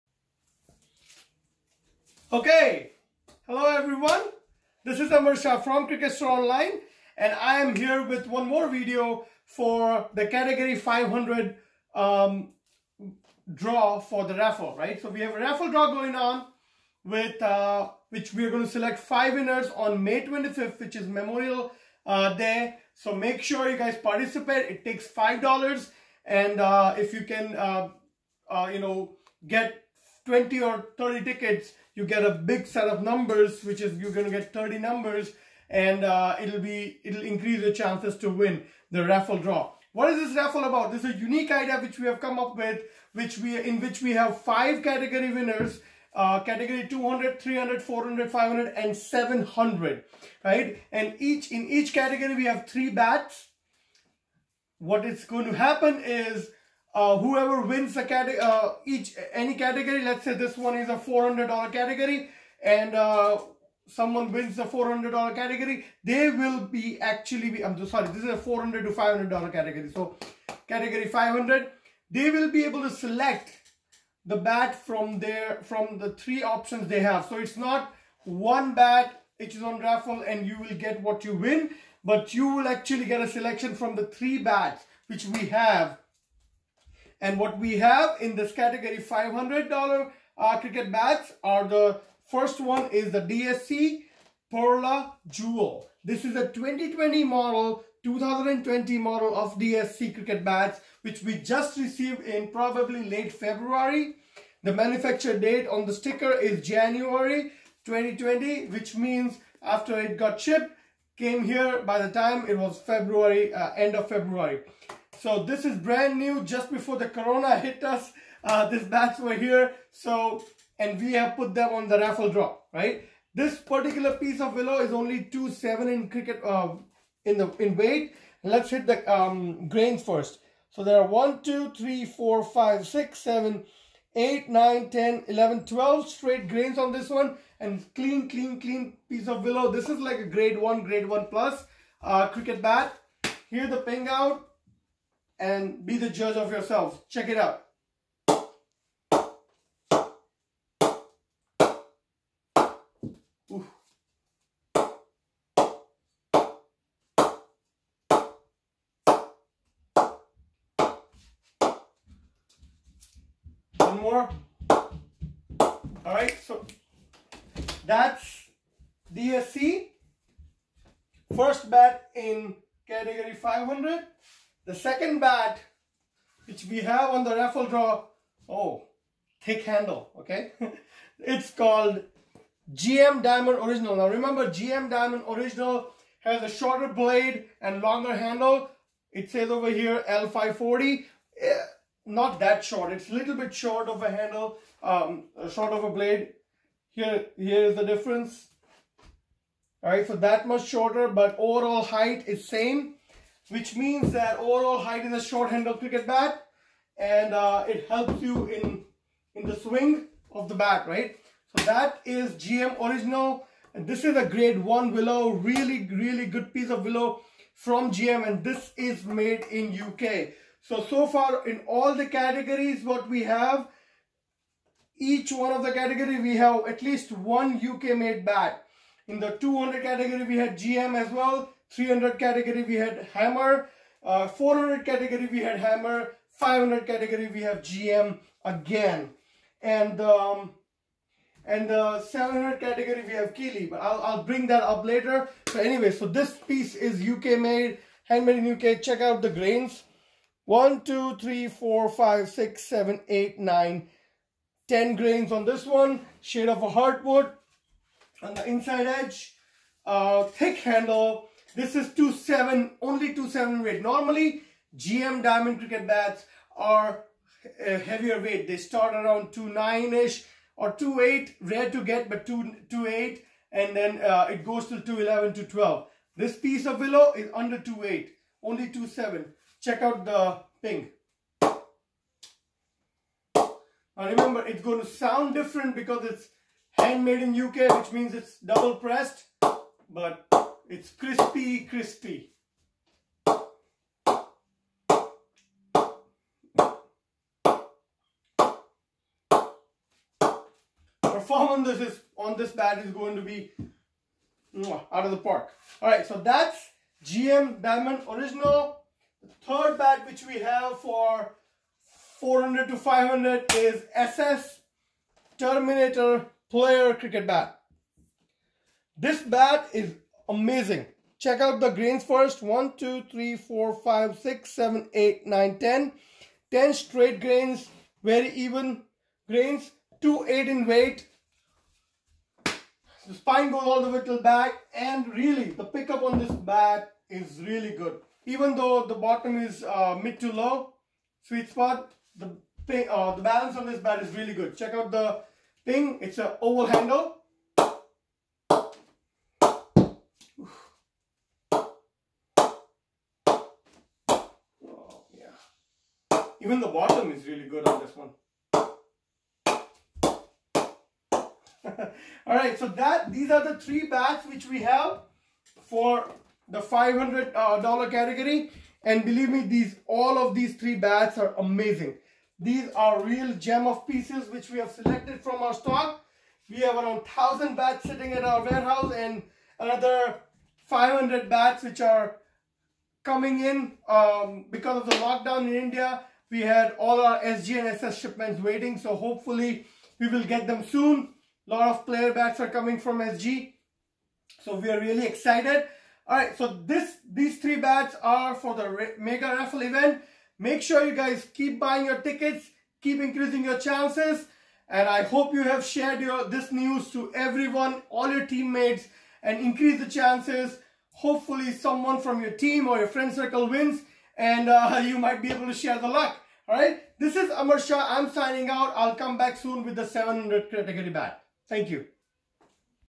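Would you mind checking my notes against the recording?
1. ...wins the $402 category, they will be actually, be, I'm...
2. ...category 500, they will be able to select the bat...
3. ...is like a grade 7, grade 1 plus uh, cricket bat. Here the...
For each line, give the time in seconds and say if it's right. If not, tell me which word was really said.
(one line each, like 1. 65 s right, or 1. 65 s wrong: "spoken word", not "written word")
1. 64 s wrong: "400", not "402"
2. 70 s right
3. 139 s wrong: "1", not "7".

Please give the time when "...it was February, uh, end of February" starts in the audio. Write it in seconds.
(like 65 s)
112 s.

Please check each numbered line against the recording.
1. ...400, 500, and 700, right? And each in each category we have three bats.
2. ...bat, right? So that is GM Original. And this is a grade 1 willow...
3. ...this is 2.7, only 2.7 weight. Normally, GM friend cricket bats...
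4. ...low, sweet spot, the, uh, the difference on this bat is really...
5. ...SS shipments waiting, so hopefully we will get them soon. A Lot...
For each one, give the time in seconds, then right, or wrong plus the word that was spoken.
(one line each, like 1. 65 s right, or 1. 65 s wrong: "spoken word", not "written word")
1. 47 s right
2. 210 s right
3. 261 s wrong: "diamond", not "friend"
4. 340 s wrong: "balance", not "difference"
5. 387 s right.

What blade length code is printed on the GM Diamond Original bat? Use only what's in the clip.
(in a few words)
L540.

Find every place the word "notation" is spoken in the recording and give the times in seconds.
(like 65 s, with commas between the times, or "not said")
not said.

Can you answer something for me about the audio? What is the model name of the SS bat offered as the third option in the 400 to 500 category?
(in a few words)
Terminator Player.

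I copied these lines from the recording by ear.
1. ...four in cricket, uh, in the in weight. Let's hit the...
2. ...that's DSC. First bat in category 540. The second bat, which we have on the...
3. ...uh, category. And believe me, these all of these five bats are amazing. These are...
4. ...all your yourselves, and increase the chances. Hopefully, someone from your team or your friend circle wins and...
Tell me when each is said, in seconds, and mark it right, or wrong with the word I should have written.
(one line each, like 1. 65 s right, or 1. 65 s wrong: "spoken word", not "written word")
1. 125 s wrong: "seven", not "four"
2. 167 s wrong: "500", not "540"
3. 367 s wrong: "three", not "five"
4. 407 s wrong: "teammates", not "yourselves".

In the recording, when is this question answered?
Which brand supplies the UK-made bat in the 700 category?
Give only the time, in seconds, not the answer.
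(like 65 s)
243 s.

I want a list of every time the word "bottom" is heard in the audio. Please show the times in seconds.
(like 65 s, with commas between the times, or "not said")
338 s, 356 s.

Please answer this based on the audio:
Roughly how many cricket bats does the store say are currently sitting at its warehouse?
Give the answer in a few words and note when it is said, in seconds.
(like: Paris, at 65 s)
1000, at 377 s.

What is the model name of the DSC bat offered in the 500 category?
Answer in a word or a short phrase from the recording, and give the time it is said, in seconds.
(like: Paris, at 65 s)
Perla Jewel, at 93 s.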